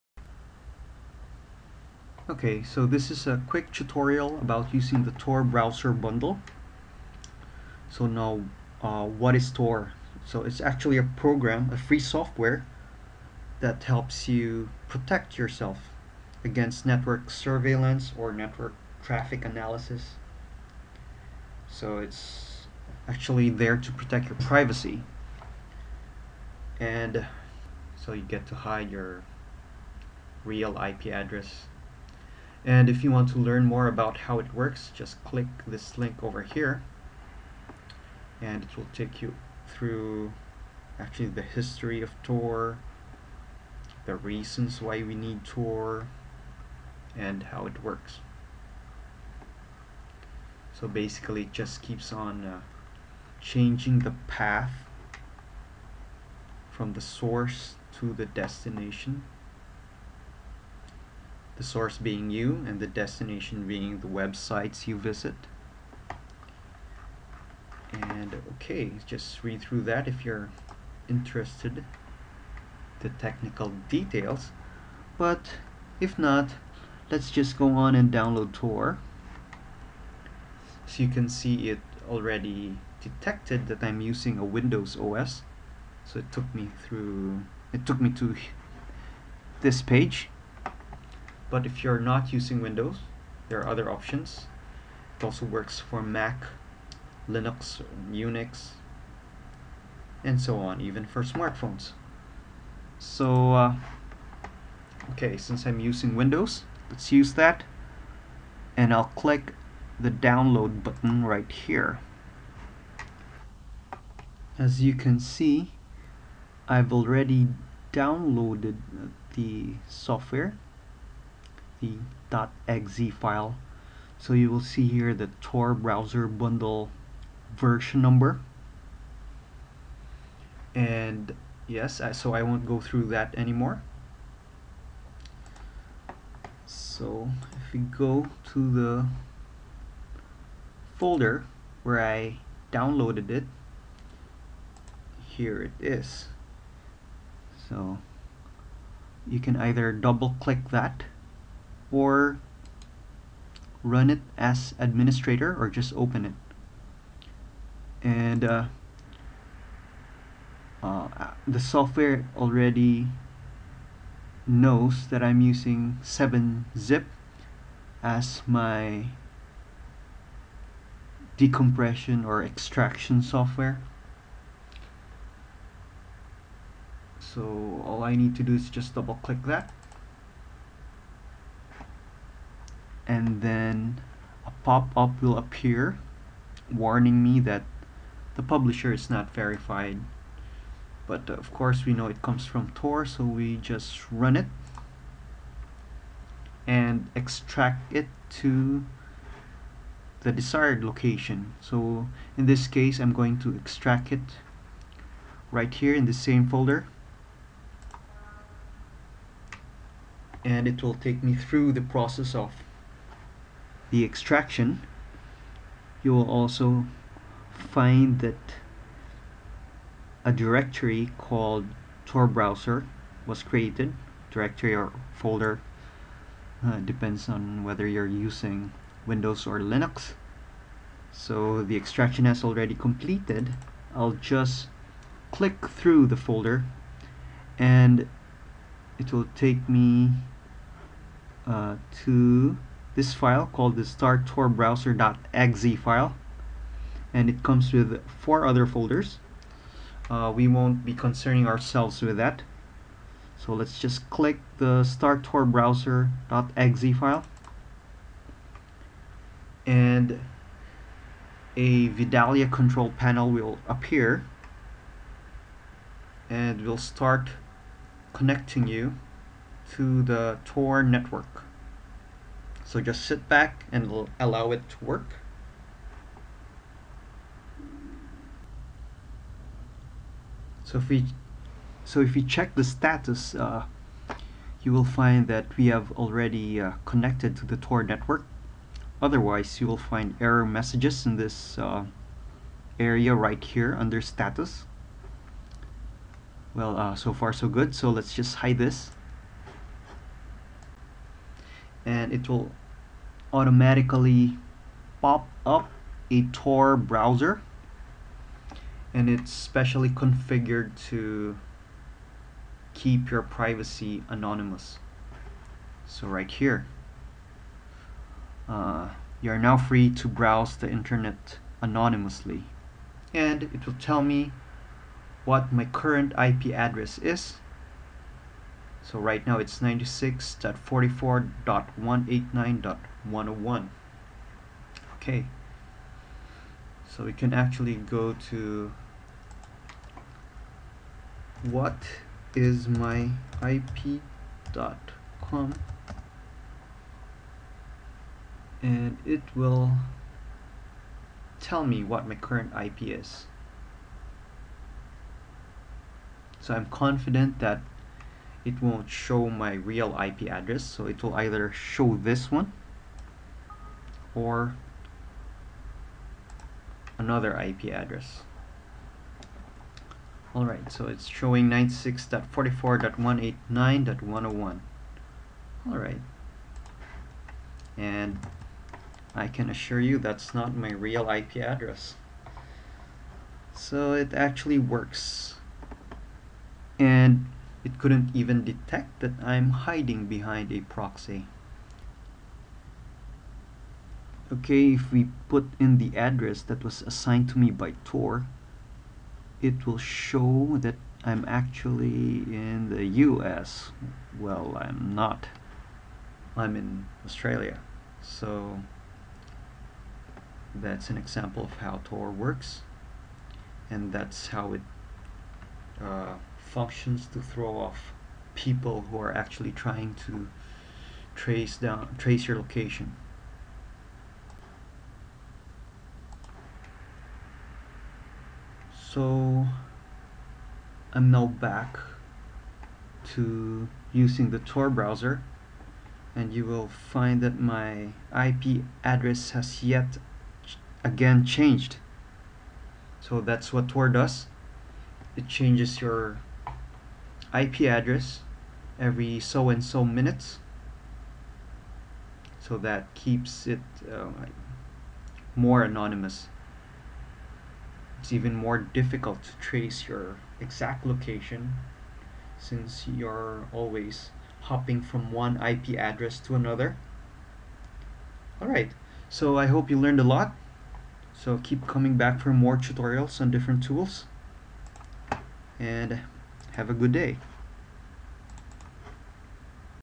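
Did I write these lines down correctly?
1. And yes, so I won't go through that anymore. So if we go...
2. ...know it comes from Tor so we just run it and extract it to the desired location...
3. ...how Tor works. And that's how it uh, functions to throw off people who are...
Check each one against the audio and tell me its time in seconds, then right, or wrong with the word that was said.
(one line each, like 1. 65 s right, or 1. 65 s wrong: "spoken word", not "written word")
1. 130 s right
2. 191 s right
3. 411 s right.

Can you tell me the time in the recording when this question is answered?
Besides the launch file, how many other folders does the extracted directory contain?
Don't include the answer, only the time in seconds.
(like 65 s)
248 s.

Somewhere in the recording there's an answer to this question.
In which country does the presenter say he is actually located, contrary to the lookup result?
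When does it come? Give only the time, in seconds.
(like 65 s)
407 s.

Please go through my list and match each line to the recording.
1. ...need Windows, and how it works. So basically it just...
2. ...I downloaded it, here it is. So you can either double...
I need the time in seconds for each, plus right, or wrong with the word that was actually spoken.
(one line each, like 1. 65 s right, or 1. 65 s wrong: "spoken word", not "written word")
1. 45 s wrong: "Tor", not "Windows"
2. 141 s right.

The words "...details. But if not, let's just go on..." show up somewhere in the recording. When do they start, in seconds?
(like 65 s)
73 s.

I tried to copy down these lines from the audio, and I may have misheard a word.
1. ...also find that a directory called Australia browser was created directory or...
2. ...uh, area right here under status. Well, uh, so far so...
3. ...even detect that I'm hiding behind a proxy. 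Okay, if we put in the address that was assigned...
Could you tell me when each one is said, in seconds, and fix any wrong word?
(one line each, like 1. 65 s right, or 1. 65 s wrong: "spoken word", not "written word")
1. 216 s wrong: "Tor", not "Australia"
2. 291 s right
3. 388 s right.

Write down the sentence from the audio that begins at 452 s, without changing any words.
So that keeps it uh, more anonymous.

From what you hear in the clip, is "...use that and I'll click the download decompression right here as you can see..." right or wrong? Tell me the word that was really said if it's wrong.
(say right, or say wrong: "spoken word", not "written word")
wrong: "button", not "decompression".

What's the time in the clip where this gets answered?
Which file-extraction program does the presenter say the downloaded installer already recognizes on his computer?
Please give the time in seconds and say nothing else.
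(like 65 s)
166 s.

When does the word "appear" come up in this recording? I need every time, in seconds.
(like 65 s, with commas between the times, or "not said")
185 s, 263 s.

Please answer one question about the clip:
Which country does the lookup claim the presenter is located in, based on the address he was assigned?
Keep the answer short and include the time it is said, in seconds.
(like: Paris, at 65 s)
US, at 403 s.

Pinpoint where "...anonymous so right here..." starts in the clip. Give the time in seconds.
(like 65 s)
314 s.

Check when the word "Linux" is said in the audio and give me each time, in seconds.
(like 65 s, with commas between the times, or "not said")
97 s, 229 s.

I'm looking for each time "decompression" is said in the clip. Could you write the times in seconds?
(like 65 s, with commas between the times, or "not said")
171 s.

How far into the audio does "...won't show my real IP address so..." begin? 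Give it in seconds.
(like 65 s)
358 s.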